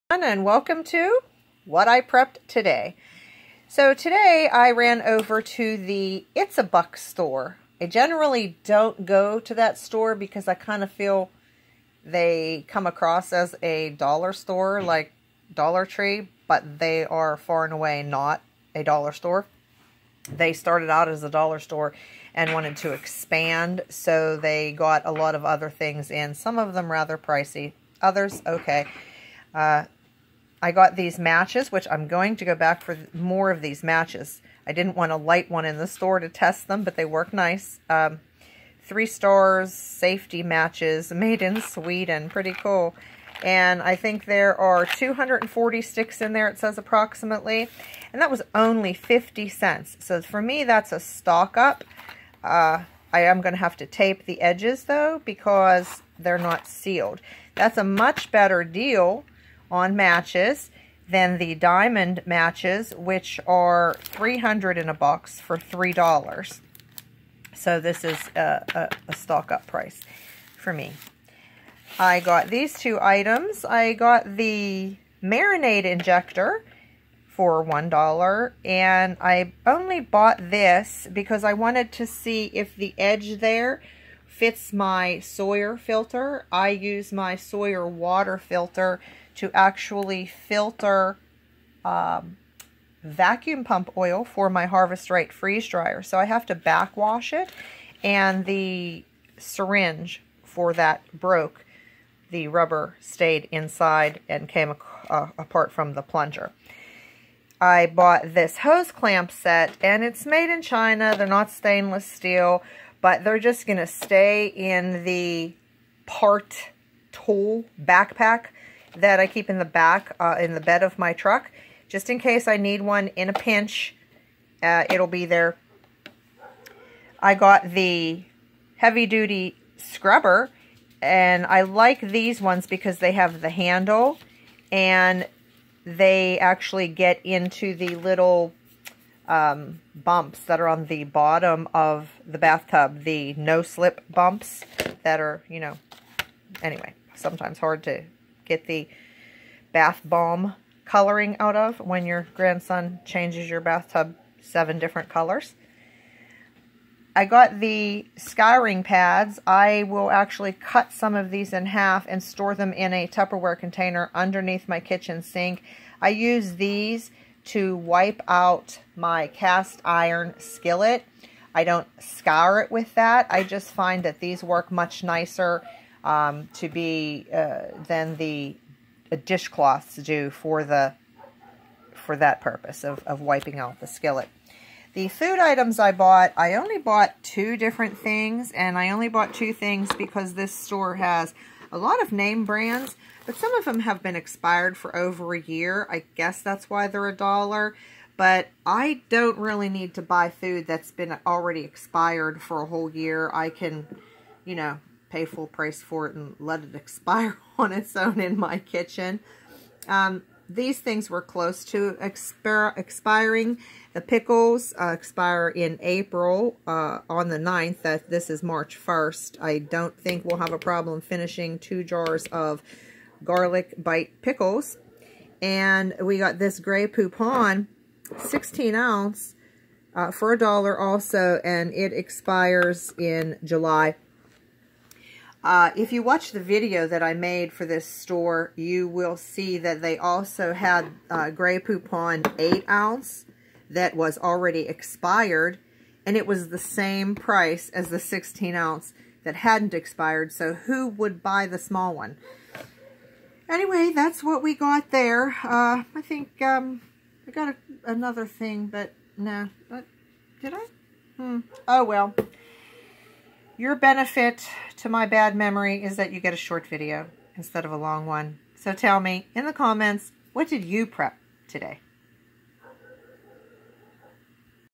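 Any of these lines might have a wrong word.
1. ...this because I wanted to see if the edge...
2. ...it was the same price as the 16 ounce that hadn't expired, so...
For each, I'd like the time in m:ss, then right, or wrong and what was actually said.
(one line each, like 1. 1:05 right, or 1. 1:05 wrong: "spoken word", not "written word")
1. 1:20 right
2. 4:06 right.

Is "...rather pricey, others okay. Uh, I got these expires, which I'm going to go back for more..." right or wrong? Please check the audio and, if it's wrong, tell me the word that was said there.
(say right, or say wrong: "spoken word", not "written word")
wrong: "matches", not "expires".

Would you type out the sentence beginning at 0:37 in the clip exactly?
Um, three stars, safety matches, made in Sweden.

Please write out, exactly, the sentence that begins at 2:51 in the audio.
I don't scour it with that.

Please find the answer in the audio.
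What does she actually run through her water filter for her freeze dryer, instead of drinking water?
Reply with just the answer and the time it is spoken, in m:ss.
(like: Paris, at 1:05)
vacuum pump oil, at 1:33.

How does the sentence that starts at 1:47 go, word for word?
I bought this hose clamp set and it's made in China.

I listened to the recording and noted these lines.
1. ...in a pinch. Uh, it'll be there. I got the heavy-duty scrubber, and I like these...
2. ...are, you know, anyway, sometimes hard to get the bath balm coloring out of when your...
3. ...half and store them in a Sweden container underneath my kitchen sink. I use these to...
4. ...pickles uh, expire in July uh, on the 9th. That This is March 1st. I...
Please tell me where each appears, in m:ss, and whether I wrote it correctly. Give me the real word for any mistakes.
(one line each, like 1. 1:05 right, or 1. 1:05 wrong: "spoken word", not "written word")
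1. 2:03 right
2. 2:25 right
3. 2:41 wrong: "Tupperware", not "Sweden"
4. 3:34 wrong: "April", not "July".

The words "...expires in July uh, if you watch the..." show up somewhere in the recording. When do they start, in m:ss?
3:51.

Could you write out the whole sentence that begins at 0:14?
like Dollar Tree, but they are far and away not a dollar store.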